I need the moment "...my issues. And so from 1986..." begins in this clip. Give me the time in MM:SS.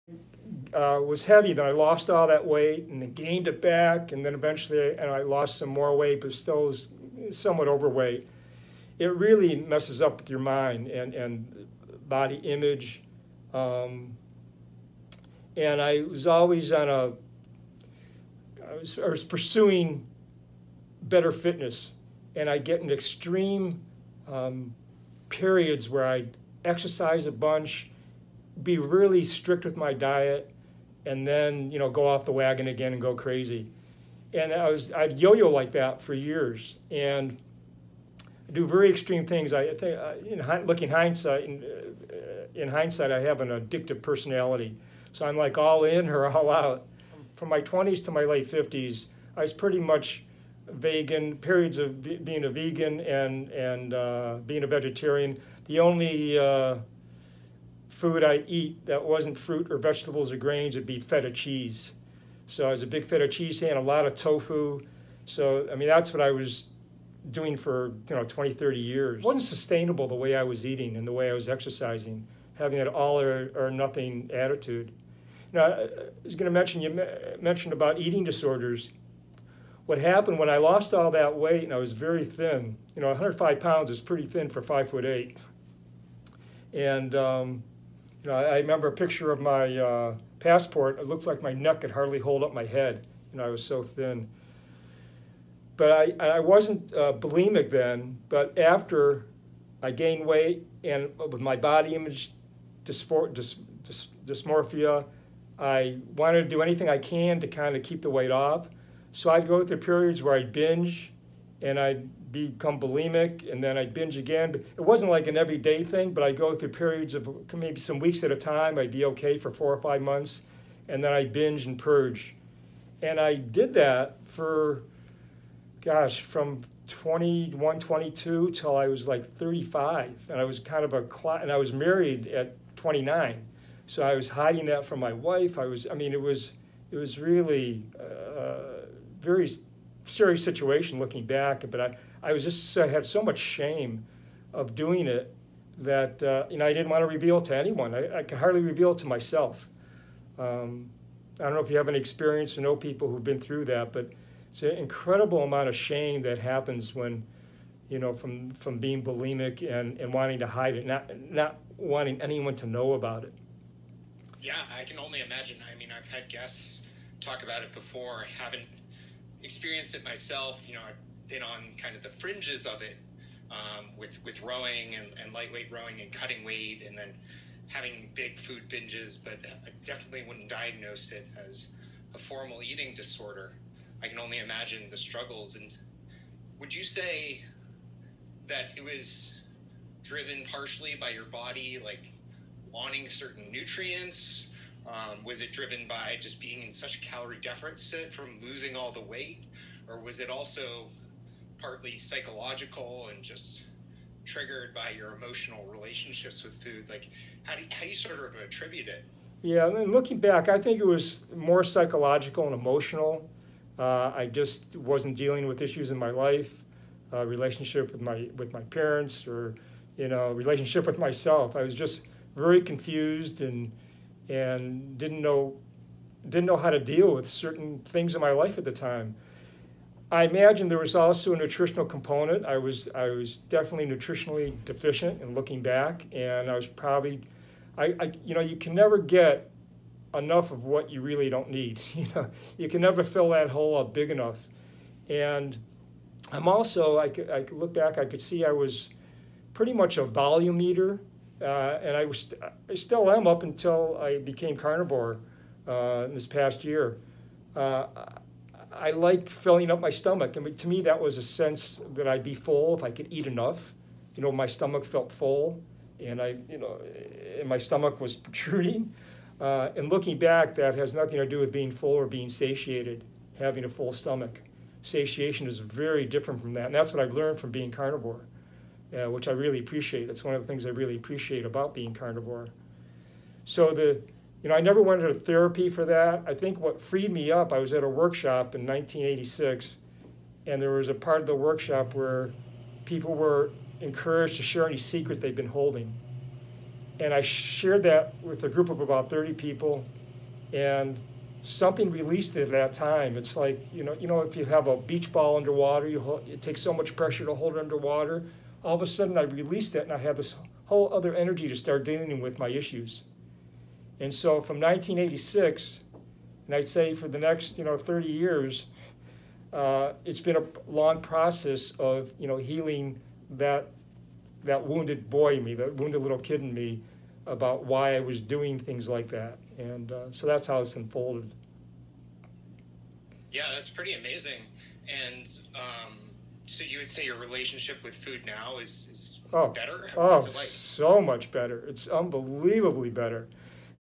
05:12.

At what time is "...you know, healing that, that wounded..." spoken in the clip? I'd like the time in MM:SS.
05:22.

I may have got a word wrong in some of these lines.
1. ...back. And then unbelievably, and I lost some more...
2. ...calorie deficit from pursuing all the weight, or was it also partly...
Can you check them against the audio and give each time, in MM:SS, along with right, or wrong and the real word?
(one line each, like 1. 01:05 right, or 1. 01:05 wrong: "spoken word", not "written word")
1. 00:03 wrong: "eventually", not "unbelievably"
2. 03:17 wrong: "losing", not "pursuing".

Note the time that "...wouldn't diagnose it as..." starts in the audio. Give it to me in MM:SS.
03:00.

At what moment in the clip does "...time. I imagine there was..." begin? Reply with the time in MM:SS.
03:48.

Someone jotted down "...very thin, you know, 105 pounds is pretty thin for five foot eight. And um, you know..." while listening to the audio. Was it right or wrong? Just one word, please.
right.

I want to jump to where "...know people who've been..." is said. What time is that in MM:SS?
02:32.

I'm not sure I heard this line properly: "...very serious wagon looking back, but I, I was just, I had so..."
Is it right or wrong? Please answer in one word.
wrong.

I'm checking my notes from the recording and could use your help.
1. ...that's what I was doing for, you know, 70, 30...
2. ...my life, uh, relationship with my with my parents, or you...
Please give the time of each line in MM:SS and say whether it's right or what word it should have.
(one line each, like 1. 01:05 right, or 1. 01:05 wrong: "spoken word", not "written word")
1. 01:05 wrong: "20", not "70"
2. 03:35 right.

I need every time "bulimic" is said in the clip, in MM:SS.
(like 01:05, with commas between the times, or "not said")
01:37, 01:52, 02:39.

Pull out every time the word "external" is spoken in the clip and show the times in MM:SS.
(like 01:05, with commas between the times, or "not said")
not said.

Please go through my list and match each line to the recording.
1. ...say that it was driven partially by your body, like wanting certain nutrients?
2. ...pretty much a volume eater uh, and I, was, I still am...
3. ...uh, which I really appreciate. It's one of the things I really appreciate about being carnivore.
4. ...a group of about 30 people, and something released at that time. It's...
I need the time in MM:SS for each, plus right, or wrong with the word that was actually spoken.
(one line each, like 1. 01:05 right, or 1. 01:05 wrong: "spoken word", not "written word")
1. 03:06 right
2. 04:09 right
3. 04:38 right
4. 04:58 right.